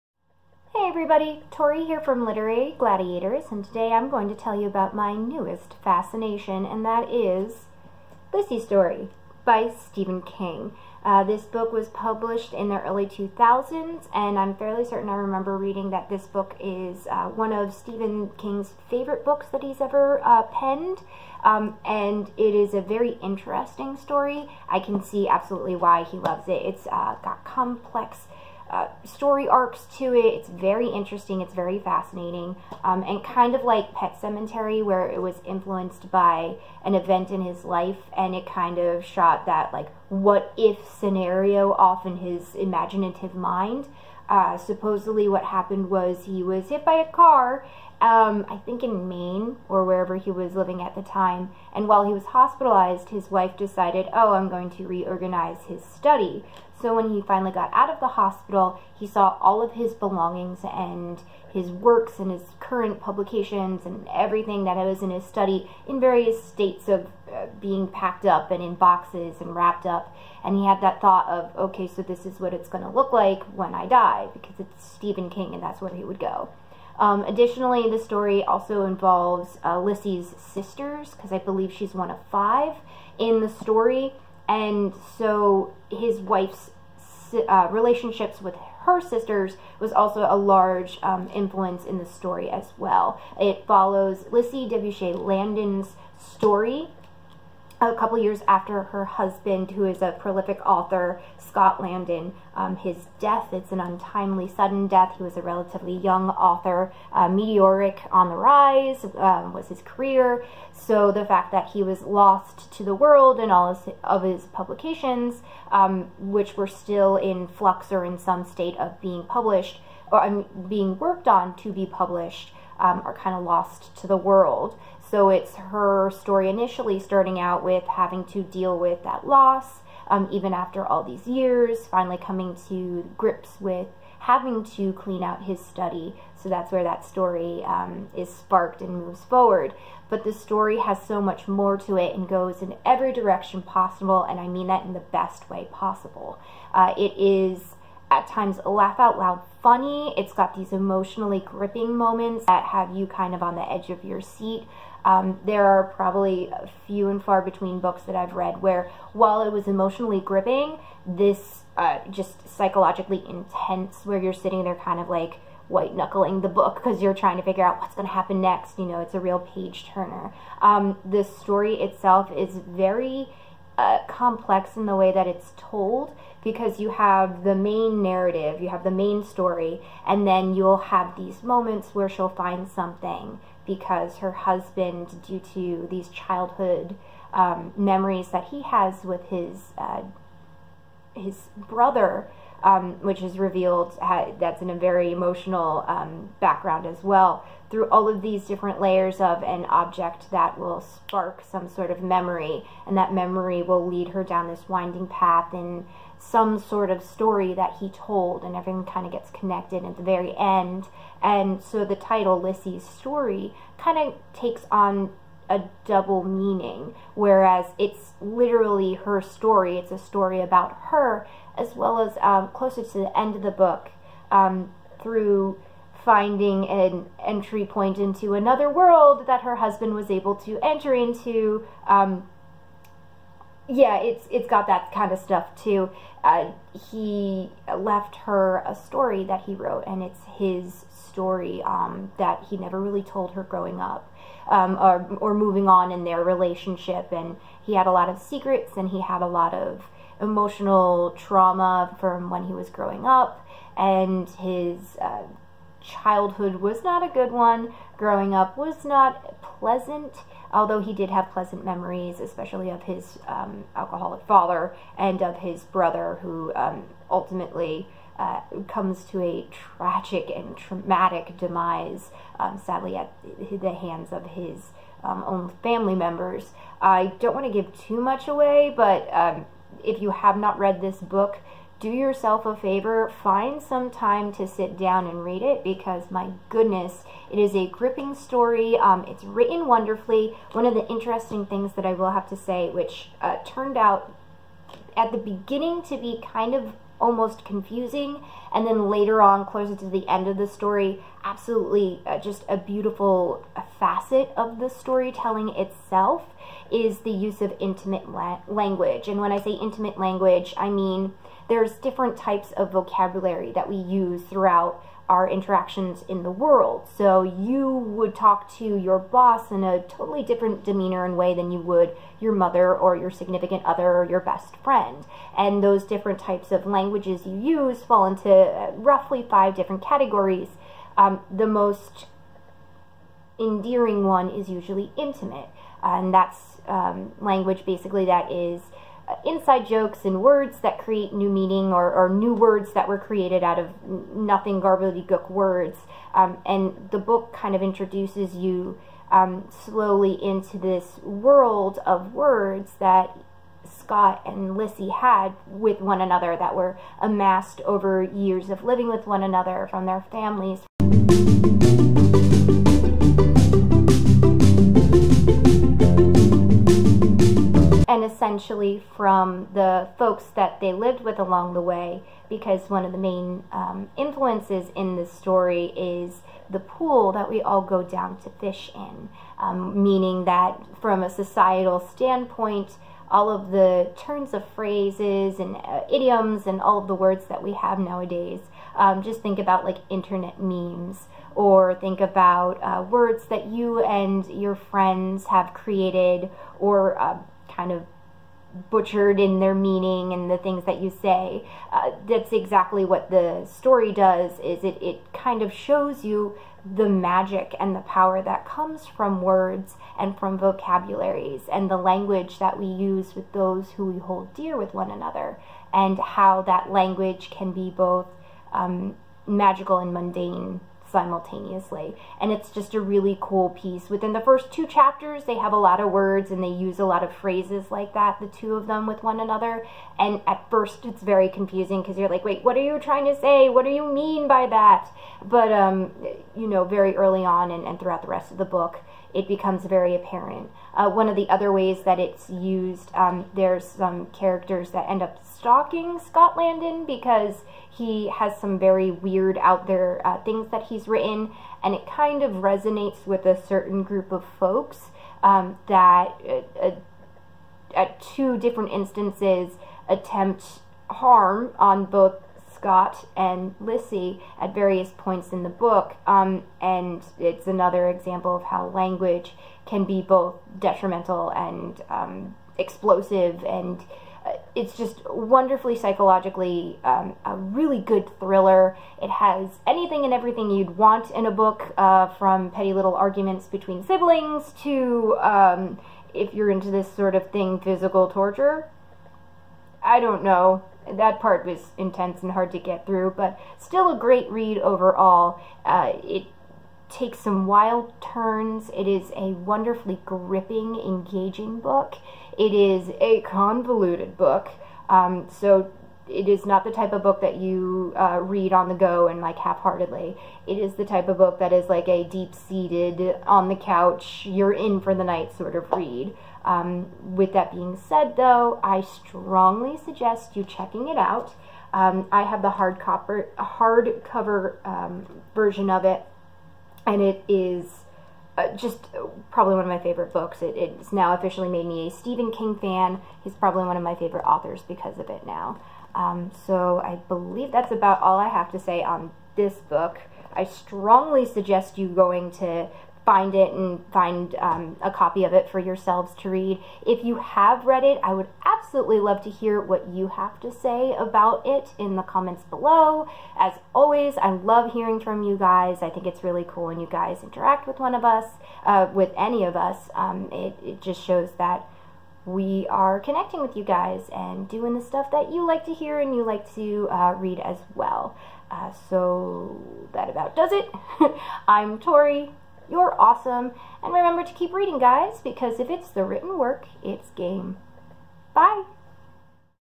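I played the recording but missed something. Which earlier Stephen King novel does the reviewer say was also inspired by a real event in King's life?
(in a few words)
Pet Sematary.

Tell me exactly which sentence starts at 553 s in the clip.
As always, I love hearing from you guys.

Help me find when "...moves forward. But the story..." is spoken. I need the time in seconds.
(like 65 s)
139 s.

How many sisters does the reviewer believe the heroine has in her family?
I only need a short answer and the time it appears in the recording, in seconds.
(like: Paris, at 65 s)
5, at 81 s.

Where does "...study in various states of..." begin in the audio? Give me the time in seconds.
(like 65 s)
65 s.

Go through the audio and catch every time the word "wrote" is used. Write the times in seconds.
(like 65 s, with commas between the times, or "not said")
239 s.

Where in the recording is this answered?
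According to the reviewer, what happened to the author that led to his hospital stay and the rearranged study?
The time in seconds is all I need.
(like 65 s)
46 s.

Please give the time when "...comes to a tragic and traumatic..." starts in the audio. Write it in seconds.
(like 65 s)
268 s.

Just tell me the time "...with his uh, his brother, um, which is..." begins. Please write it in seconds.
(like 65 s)
189 s.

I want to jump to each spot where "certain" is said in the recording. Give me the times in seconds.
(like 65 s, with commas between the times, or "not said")
14 s, 453 s.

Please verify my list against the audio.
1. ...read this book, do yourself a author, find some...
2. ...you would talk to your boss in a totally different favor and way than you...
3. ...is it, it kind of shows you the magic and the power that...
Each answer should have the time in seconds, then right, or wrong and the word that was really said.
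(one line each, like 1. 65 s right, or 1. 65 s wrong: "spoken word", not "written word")
1. 280 s wrong: "favor", not "author"
2. 317 s wrong: "demeanor", not "favor"
3. 404 s right.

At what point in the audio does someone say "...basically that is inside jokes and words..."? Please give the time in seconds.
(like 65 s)
337 s.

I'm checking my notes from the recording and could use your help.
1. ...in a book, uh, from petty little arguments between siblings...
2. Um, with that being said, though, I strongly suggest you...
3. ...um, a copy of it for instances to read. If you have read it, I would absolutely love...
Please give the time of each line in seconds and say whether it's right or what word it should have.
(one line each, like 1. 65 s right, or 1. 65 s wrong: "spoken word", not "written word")
1. 481 s right
2. 516 s right
3. 544 s wrong: "yourselves", not "instances".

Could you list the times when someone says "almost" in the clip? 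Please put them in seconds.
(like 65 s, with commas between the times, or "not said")
297 s.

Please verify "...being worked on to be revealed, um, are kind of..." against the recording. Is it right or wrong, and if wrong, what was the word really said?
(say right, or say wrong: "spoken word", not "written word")
wrong: "published", not "revealed".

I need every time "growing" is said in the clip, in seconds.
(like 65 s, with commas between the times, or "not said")
243 s, 252 s, 257 s.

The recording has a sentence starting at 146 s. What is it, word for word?
Uh, it is at times laugh out loud funny.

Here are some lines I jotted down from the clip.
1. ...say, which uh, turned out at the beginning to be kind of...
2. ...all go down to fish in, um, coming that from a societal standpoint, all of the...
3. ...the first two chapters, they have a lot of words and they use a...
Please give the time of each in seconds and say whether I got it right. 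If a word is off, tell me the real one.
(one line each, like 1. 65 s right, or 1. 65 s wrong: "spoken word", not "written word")
1. 292 s right
2. 377 s wrong: "meaning", not "coming"
3. 424 s right.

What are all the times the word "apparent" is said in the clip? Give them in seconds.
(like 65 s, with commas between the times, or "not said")
439 s.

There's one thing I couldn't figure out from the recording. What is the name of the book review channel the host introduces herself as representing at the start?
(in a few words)
Literary Gladiators.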